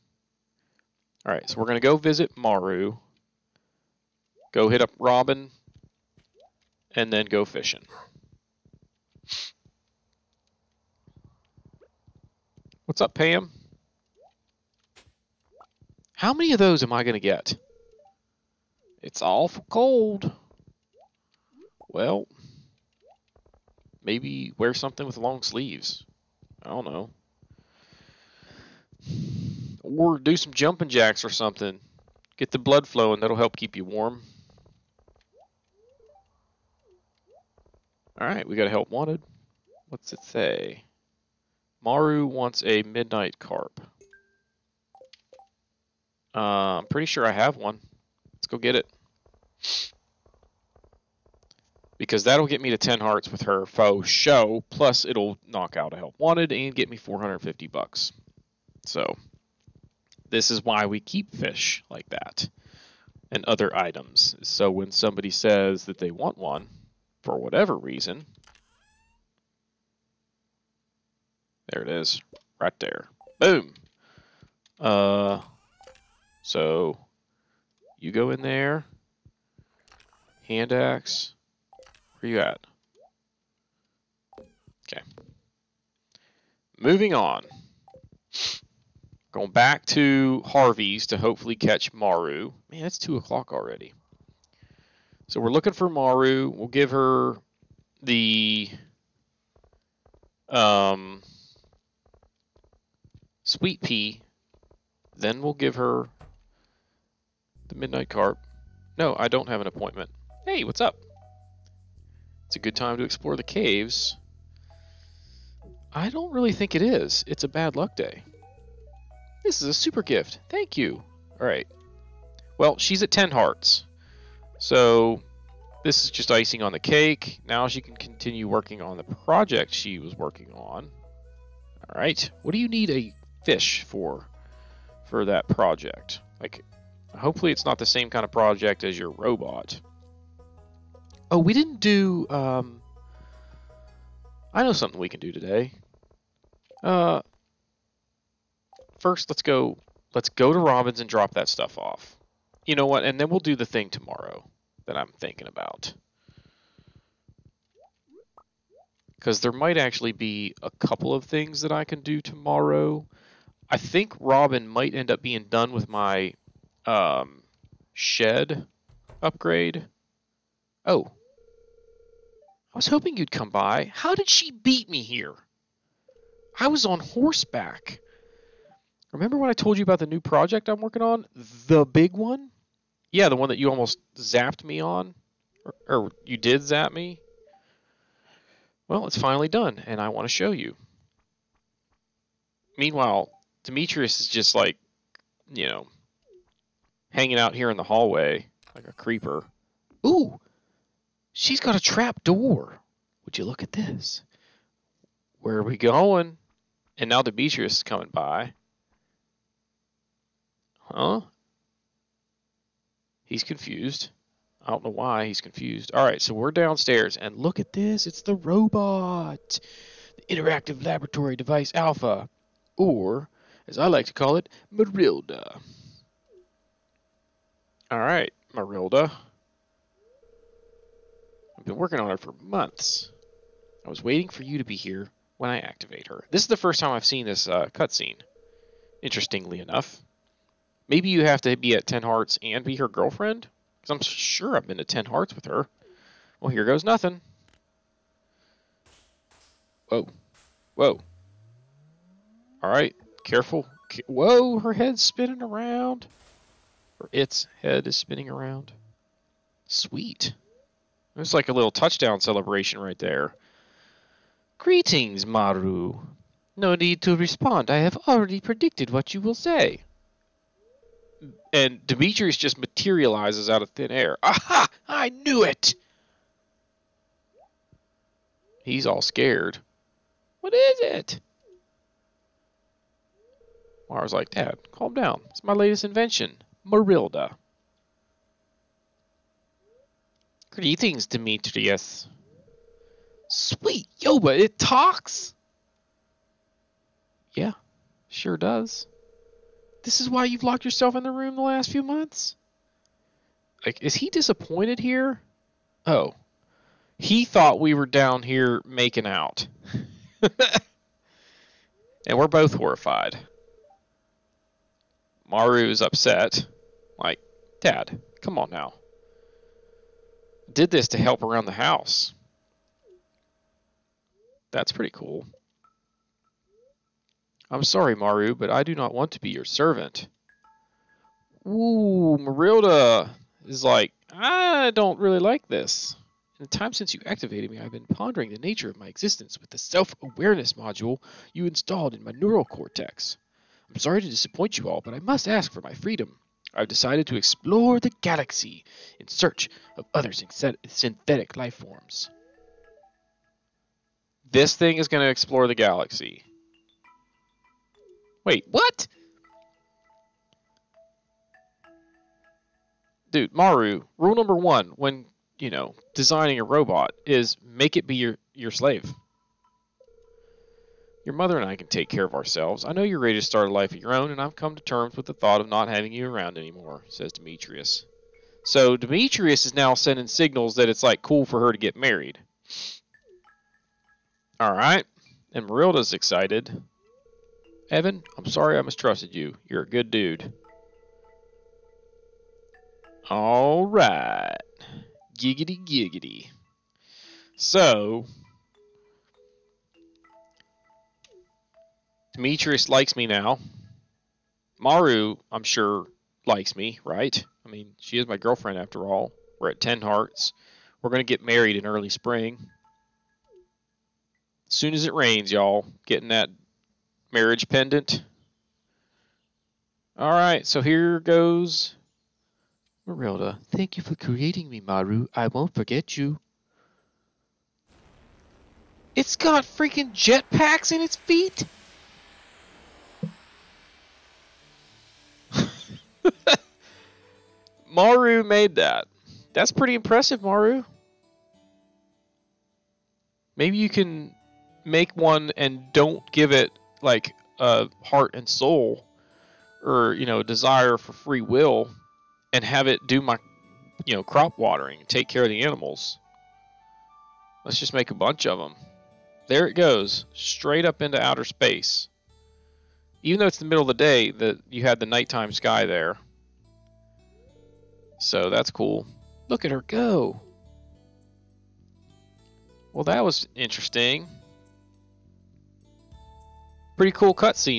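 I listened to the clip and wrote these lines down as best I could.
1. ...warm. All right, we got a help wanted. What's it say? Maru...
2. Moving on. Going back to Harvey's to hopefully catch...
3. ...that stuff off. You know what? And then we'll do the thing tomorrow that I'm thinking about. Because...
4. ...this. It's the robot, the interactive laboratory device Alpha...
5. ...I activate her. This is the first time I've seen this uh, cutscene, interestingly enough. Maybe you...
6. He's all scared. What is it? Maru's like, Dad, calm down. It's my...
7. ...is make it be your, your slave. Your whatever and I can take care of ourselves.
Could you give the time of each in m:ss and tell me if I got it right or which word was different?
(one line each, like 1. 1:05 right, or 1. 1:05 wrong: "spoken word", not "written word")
1. 0:33 right
2. 1:26 right
3. 2:31 right
4. 3:37 right
5. 3:55 right
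6. 4:38 right
7. 6:07 wrong: "mother", not "whatever".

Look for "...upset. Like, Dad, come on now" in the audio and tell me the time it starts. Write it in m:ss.
5:15.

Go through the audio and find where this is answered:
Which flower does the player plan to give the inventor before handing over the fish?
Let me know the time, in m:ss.
1:43.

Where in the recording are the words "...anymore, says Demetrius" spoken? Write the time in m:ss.
6:16.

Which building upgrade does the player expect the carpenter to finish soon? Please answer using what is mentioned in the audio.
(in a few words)
Shed upgrade.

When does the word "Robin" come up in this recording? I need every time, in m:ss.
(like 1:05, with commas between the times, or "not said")
0:04, 2:30, 2:44.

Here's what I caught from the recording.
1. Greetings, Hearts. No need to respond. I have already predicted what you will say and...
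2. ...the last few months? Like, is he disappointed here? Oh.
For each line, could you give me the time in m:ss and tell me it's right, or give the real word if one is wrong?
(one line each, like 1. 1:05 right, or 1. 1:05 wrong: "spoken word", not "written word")
1. 4:24 wrong: "Maru", not "Hearts"
2. 5:01 right.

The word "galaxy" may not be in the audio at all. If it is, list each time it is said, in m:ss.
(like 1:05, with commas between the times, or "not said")
5:48, 5:55.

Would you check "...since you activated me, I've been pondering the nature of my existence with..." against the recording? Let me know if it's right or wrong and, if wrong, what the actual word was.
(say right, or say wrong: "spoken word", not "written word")
right.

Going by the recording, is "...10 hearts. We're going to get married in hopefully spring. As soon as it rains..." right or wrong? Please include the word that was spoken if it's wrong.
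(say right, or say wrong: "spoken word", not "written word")
wrong: "early", not "hopefully".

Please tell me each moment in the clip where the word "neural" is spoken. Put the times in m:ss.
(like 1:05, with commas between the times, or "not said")
5:42.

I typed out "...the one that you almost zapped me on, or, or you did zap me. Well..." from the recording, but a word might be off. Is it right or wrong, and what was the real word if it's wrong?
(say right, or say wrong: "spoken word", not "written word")
right.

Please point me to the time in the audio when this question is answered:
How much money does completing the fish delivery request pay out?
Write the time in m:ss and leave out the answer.
0:56.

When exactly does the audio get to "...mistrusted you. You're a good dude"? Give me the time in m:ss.
6:28.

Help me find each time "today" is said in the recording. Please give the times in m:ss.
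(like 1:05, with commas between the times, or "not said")
2:25.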